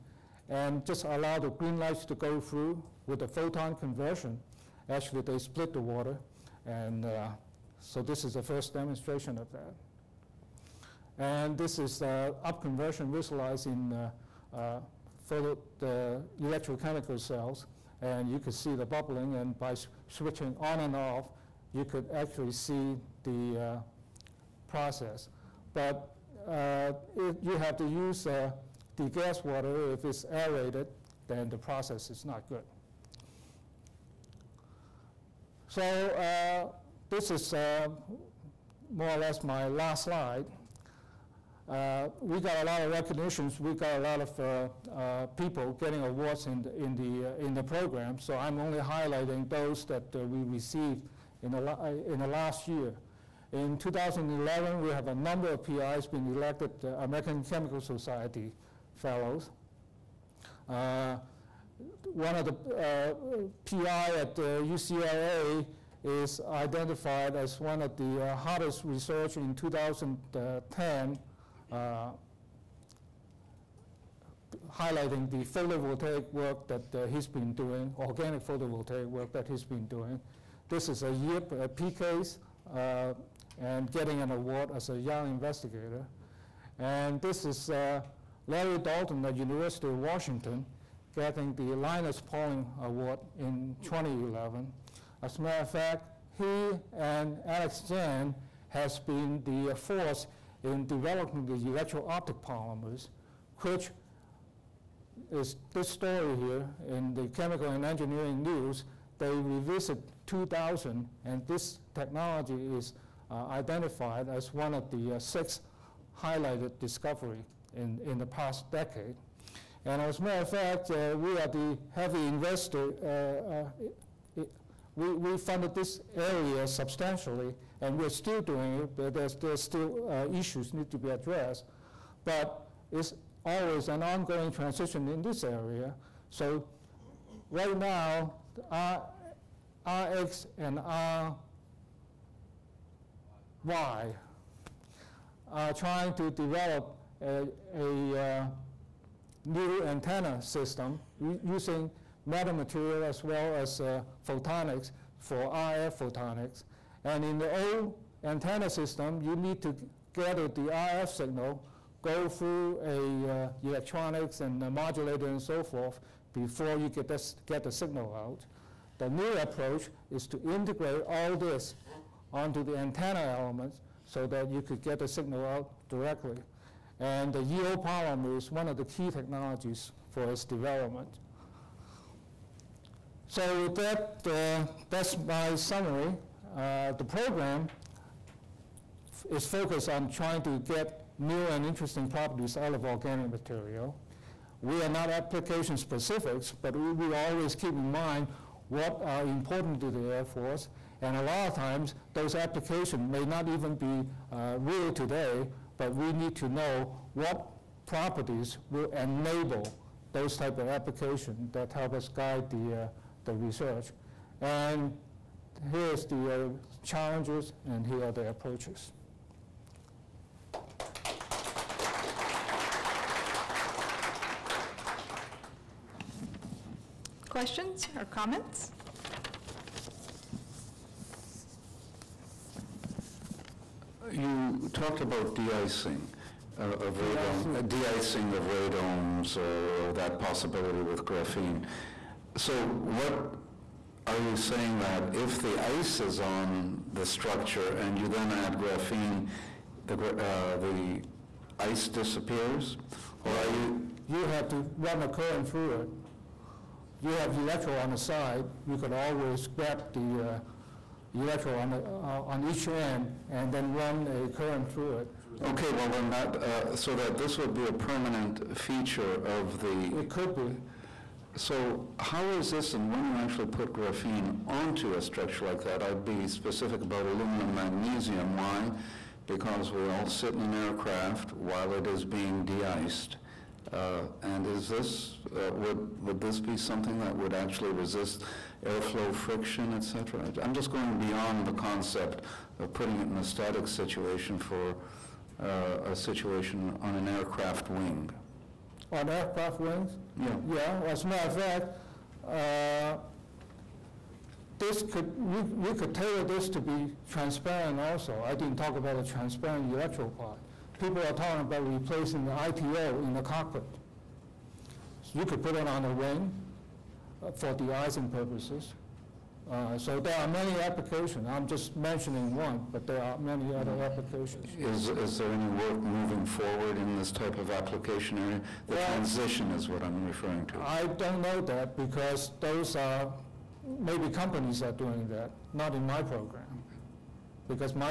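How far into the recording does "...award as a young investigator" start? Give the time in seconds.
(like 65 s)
84 s.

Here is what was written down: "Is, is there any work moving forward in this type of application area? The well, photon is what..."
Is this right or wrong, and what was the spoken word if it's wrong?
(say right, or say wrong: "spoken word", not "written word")
wrong: "transition", not "photon".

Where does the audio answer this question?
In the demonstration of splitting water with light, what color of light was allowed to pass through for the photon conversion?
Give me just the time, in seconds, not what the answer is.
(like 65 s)
1 s.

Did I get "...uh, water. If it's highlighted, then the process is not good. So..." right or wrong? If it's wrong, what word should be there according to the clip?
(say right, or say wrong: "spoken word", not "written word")
wrong: "aerated", not "highlighted".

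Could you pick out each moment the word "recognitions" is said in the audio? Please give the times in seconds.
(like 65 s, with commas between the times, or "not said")
42 s.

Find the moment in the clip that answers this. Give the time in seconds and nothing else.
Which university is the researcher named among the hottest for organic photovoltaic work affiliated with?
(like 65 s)
64 s.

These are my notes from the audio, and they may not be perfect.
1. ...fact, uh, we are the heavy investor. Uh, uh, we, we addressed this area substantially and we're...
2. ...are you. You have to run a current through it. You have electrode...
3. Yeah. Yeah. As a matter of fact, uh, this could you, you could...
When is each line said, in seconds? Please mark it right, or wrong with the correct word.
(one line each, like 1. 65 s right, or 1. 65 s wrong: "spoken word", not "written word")
1. 120 s wrong: "funded", not "addressed"
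2. 253 s right
3. 300 s right.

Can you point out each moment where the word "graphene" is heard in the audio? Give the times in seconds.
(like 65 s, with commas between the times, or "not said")
241 s, 248 s, 273 s.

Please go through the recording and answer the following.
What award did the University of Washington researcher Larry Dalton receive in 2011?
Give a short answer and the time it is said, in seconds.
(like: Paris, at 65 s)
Linus Pauling Award, at 91 s.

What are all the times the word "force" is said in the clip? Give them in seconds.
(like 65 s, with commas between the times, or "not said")
99 s, 200 s.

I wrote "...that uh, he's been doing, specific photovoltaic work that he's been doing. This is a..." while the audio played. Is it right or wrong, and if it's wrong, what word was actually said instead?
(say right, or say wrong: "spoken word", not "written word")
wrong: "organic", not "specific".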